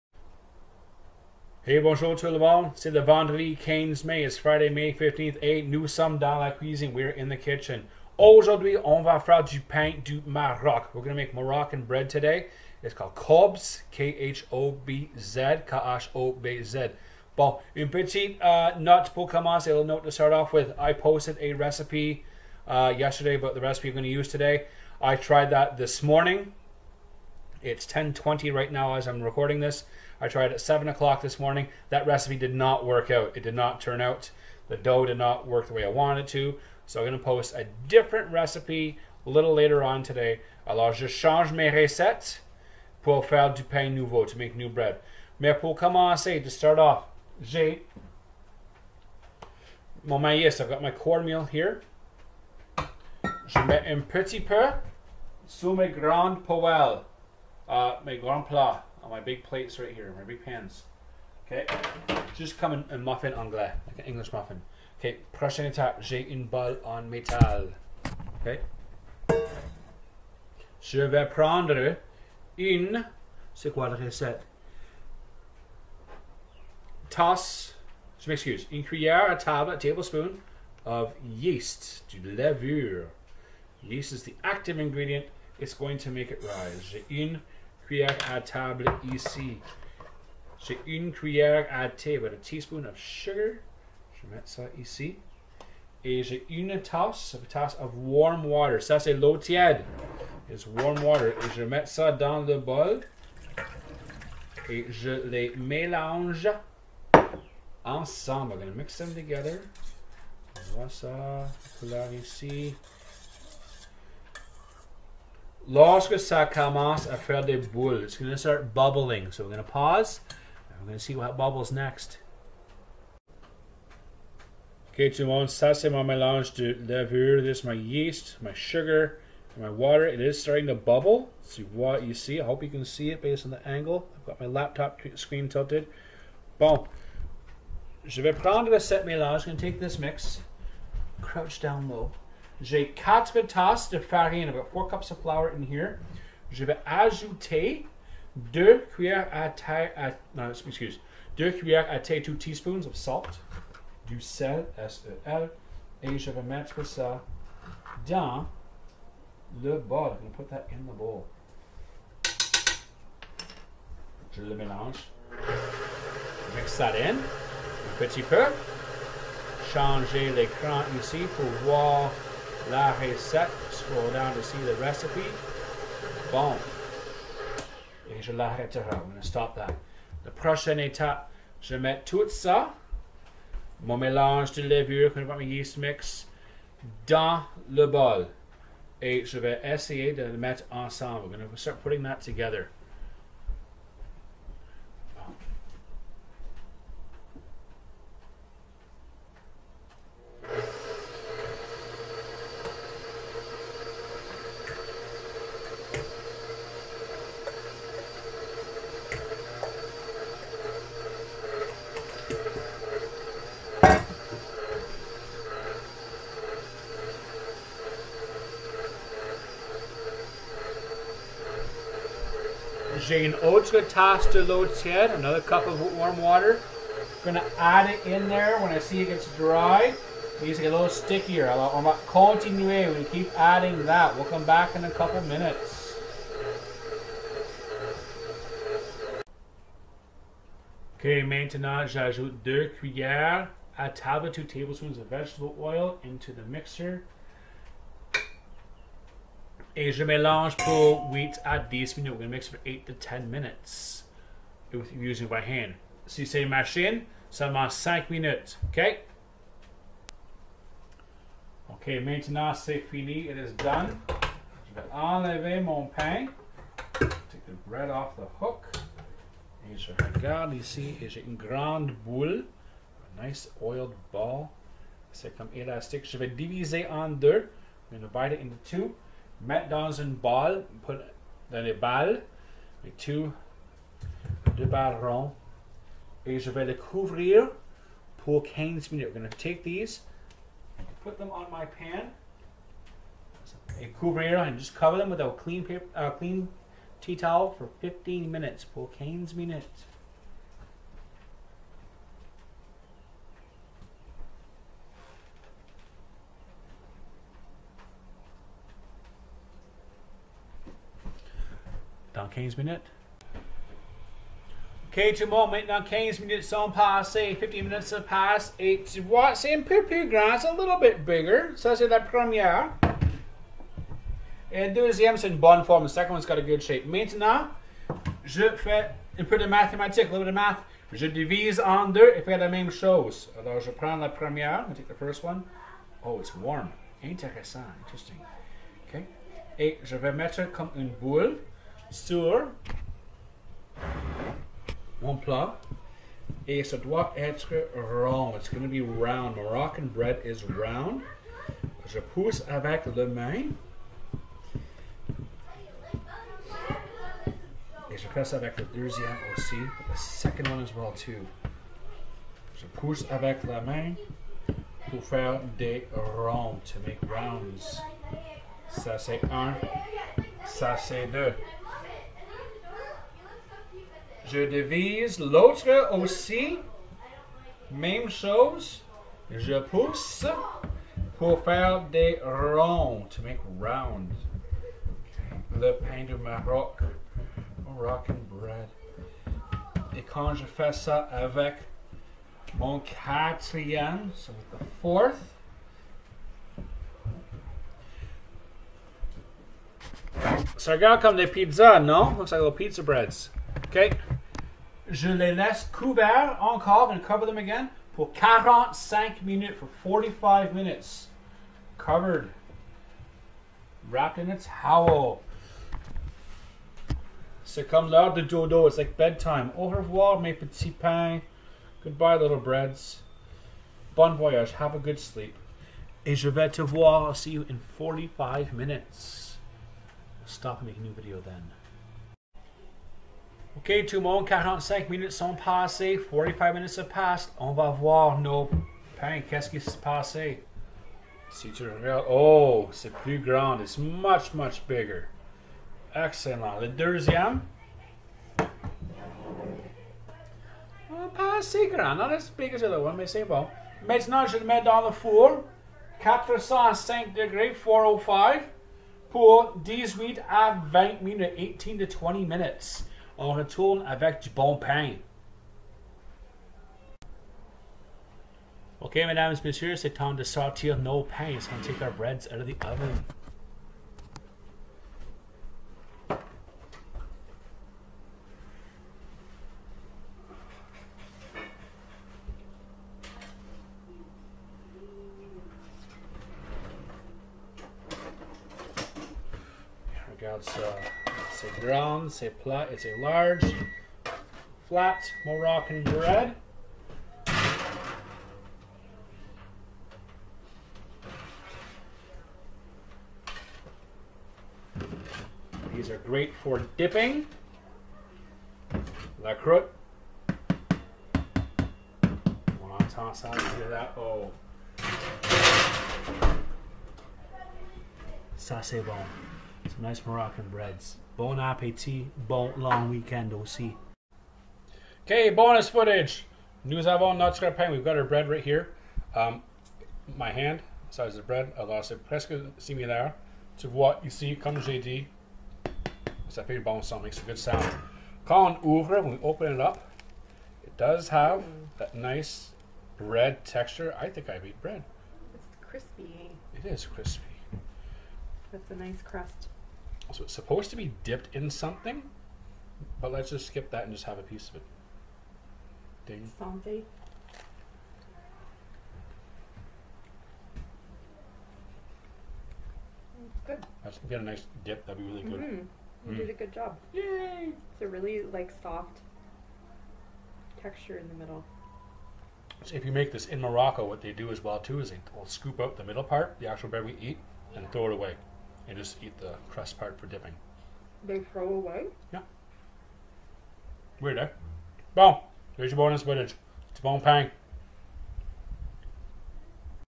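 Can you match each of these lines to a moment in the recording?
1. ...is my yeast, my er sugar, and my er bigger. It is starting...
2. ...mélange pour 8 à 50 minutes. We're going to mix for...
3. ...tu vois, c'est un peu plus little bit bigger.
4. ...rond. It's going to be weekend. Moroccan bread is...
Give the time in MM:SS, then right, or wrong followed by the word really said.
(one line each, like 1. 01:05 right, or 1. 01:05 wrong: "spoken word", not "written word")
1. 02:07 wrong: "water", not "bigger"
2. 04:10 wrong: "10", not "50"
3. 05:18 right
4. 05:47 wrong: "round", not "weekend".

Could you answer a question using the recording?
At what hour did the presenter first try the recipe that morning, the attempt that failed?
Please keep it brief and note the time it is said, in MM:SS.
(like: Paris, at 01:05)
7 o'clock, at 00:30.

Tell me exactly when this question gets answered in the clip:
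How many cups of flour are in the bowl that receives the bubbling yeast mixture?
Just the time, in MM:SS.
02:24.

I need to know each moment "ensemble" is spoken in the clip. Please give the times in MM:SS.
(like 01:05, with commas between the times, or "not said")
01:47, 03:10.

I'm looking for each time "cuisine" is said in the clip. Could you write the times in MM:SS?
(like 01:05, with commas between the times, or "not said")
00:06.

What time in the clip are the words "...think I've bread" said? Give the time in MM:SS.
09:04.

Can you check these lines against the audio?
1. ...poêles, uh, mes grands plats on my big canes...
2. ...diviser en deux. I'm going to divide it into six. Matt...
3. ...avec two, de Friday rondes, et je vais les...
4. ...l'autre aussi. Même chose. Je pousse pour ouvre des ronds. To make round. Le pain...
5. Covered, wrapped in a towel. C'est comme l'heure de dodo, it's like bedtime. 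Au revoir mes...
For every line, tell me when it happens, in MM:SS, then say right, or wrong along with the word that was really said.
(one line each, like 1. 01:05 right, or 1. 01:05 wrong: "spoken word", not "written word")
1. 00:56 wrong: "plates", not "canes"
2. 04:36 wrong: "two", not "six"
3. 04:42 wrong: "Baron", not "Friday"
4. 06:15 wrong: "faire", not "ouvre"
5. 06:51 right.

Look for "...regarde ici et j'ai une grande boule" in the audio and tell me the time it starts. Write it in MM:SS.
04:30.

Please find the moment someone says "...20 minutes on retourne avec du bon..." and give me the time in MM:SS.
07:41.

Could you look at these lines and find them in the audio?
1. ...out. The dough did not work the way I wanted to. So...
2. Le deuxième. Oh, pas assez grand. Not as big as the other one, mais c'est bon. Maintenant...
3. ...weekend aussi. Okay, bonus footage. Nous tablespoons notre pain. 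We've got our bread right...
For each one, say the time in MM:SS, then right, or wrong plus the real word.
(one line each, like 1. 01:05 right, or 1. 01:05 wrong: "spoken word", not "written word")
1. 00:33 right
2. 07:26 right
3. 08:42 wrong: "avons", not "tablespoons".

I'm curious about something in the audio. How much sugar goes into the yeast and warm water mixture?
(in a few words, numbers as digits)
1 teaspoon.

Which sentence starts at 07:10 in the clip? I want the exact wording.
stop and make a new video then.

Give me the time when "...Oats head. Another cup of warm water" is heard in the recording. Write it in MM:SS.
03:44.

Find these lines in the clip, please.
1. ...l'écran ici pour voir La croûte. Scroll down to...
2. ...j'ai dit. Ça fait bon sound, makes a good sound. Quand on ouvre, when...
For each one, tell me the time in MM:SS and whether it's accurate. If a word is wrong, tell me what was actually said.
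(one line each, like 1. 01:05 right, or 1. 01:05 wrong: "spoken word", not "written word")
1. 02:50 wrong: "recette", not "croûte"
2. 08:54 right.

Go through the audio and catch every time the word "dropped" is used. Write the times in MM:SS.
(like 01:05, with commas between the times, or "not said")
not said.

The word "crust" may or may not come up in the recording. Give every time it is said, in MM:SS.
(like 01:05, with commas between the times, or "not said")
09:09, 09:39.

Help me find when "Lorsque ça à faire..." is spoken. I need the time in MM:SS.
01:55.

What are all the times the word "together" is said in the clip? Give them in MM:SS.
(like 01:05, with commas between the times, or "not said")
01:49, 03:12.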